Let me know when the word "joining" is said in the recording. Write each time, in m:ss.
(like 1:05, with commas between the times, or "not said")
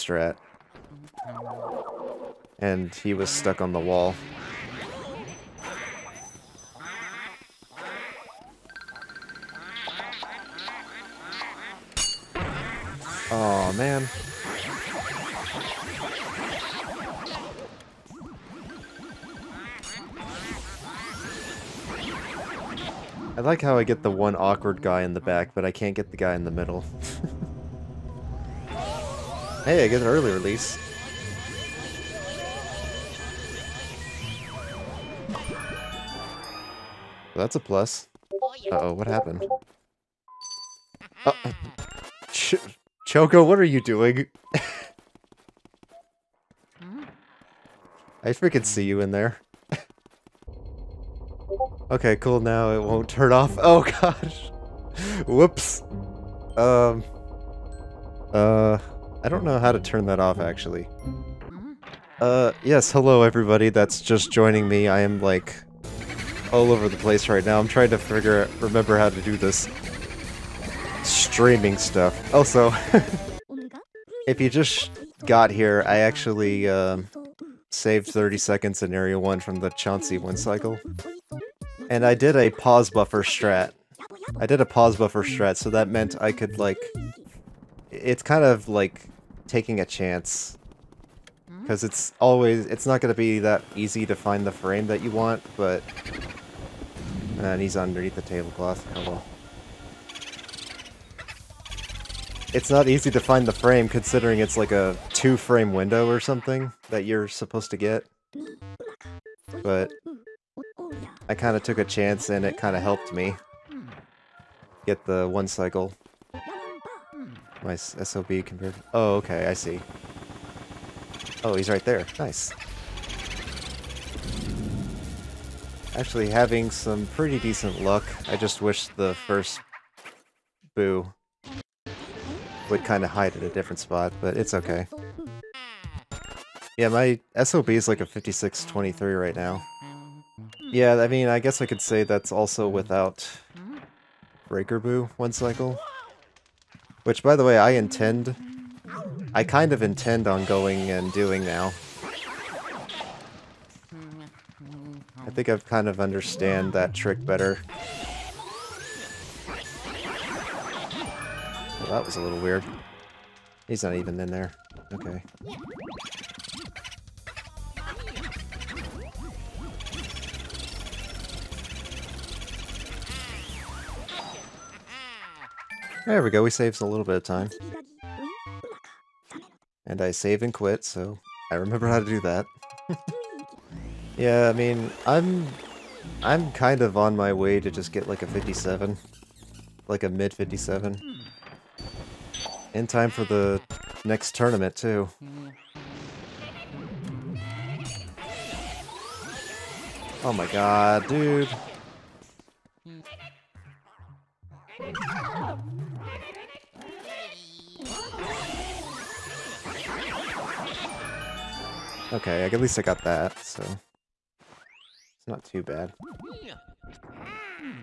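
1:04.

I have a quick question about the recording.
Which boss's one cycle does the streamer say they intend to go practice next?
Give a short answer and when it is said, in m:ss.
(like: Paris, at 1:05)
Breaker Boo, at 2:24.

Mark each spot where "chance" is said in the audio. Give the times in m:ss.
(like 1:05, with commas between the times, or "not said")
1:29, 1:51.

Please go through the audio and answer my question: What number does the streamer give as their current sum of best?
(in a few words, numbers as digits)
5623.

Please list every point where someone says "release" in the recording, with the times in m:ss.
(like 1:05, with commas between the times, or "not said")
0:30.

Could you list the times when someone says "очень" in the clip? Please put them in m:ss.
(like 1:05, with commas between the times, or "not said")
not said.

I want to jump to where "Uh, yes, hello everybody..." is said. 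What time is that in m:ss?
1:02.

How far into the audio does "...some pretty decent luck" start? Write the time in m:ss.
2:06.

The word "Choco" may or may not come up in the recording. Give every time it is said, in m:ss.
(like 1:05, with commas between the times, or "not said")
0:43.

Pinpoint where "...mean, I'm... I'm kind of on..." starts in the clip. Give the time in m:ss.
3:04.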